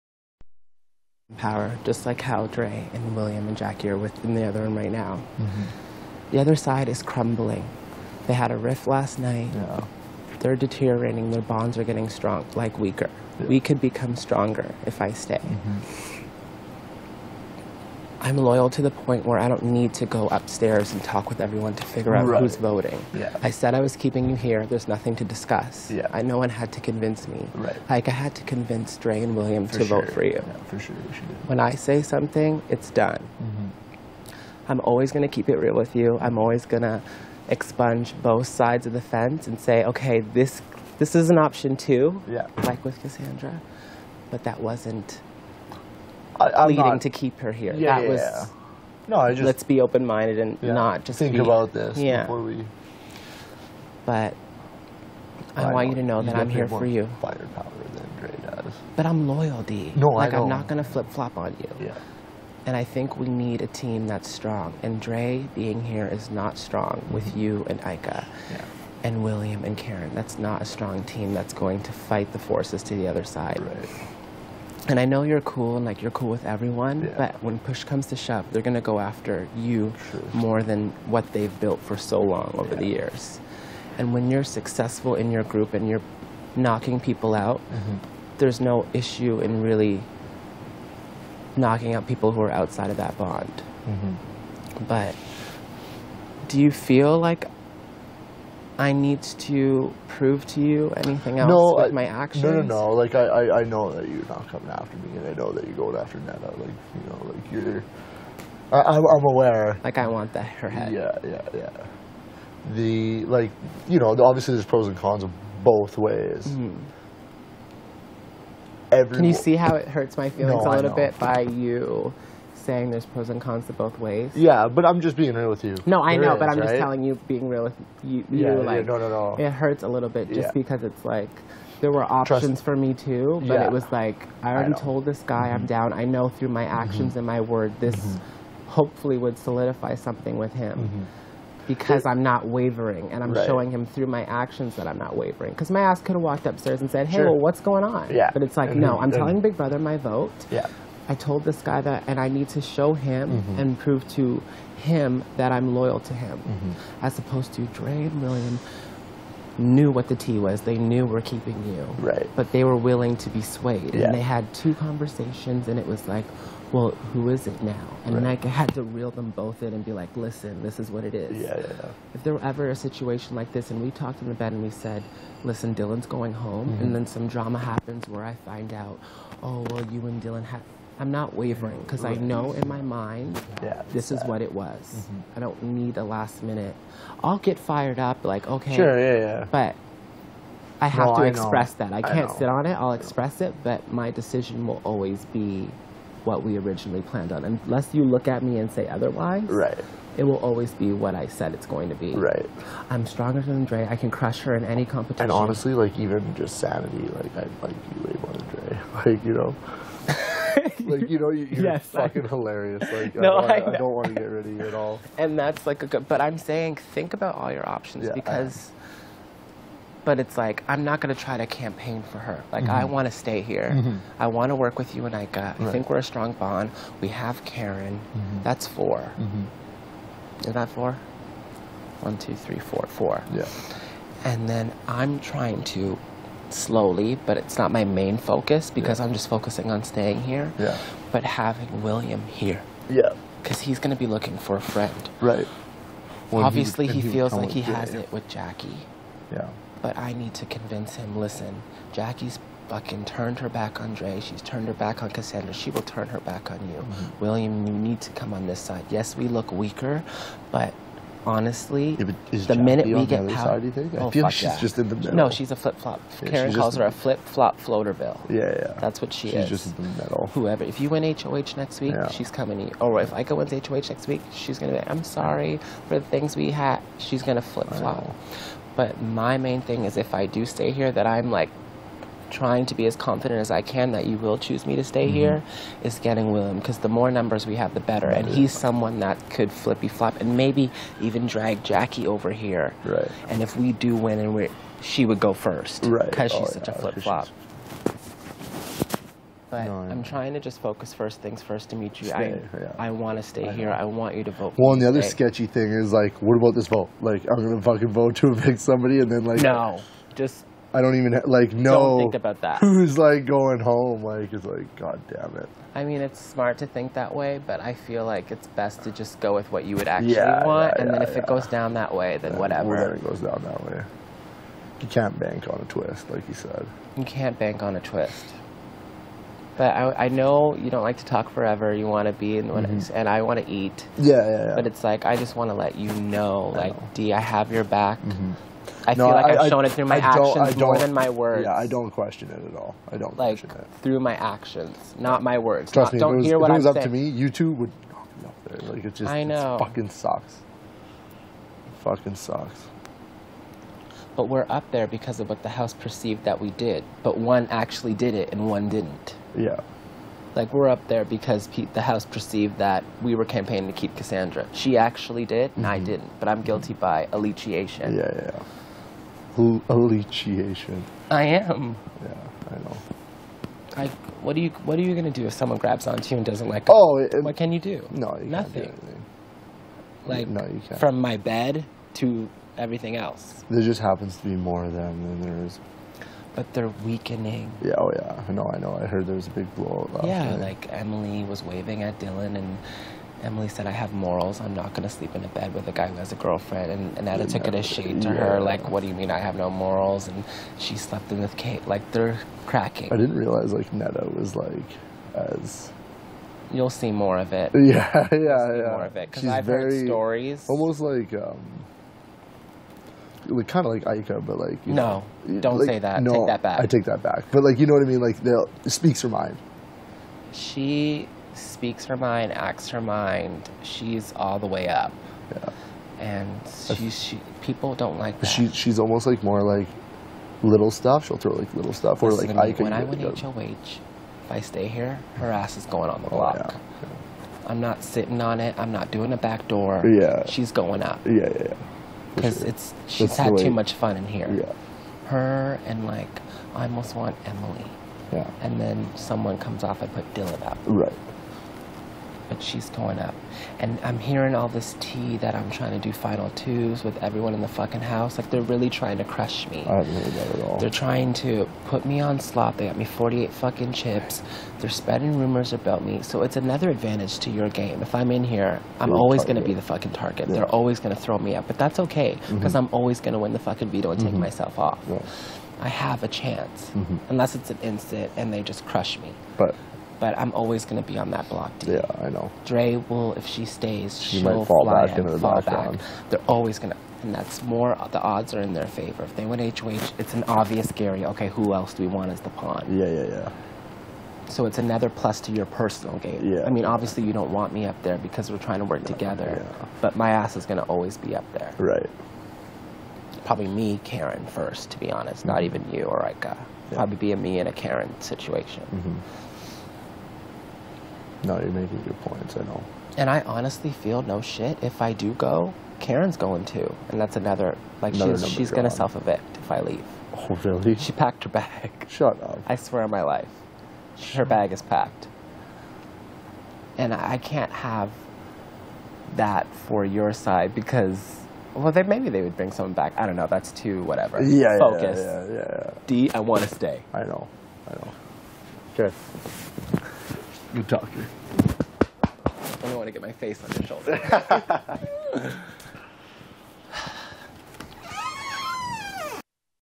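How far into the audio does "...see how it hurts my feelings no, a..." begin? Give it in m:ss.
1:59.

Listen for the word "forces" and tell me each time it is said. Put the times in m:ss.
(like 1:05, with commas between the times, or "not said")
1:12.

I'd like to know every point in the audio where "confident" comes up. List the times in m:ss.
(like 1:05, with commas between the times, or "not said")
4:42.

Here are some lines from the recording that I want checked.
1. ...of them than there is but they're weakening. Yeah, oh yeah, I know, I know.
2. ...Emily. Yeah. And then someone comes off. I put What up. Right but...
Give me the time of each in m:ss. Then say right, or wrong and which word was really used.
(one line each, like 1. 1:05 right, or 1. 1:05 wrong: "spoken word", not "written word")
1. 6:24 right
2. 7:27 wrong: "Dillon", not "What".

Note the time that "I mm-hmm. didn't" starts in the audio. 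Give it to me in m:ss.
6:05.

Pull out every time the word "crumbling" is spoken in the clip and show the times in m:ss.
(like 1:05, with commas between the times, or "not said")
0:07.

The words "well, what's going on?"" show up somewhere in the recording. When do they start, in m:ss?
2:27.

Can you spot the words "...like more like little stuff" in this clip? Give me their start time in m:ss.
7:09.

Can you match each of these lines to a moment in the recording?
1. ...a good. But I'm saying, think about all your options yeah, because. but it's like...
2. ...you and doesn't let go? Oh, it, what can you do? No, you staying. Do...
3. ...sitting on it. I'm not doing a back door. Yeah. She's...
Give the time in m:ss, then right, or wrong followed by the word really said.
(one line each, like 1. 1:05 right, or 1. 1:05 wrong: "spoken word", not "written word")
1. 3:35 right
2. 6:16 wrong: "nothing", not "staying"
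3. 7:17 right.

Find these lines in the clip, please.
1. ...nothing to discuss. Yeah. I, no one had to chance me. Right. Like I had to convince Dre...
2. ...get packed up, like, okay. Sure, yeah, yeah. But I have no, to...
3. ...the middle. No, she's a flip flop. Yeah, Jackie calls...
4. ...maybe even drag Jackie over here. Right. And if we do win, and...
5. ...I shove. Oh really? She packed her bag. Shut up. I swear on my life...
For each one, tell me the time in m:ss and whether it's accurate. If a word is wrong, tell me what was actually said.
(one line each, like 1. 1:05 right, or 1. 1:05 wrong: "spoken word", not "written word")
1. 0:24 wrong: "convince", not "chance"
2. 3:07 wrong: "fired", not "packed"
3. 4:24 wrong: "Karen", not "Jackie"
4. 4:50 right
5. 8:39 wrong: "leave", not "shove".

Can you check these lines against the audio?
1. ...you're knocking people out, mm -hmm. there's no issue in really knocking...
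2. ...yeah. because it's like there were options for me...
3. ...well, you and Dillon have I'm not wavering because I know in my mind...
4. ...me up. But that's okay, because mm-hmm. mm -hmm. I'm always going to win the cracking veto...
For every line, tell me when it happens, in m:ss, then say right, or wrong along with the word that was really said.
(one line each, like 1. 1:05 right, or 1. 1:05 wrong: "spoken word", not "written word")
1. 1:25 right
2. 2:10 right
3. 2:59 right
4. 7:51 wrong: "fucking", not "cracking".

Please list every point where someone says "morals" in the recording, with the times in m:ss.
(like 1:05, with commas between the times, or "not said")
6:33, 6:39.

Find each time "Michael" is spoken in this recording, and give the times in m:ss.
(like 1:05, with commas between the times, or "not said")
not said.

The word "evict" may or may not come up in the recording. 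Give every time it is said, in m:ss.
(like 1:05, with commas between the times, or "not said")
5:08, 8:38.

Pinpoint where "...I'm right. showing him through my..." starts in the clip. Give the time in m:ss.
2:23.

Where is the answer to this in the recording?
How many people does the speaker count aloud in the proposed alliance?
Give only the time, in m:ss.
3:48.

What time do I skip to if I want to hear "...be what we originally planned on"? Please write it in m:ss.
3:15.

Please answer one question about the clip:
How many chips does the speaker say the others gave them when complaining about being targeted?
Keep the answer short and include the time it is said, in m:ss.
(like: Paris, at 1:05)
48, at 7:42.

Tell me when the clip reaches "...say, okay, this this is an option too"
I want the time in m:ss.
0:39.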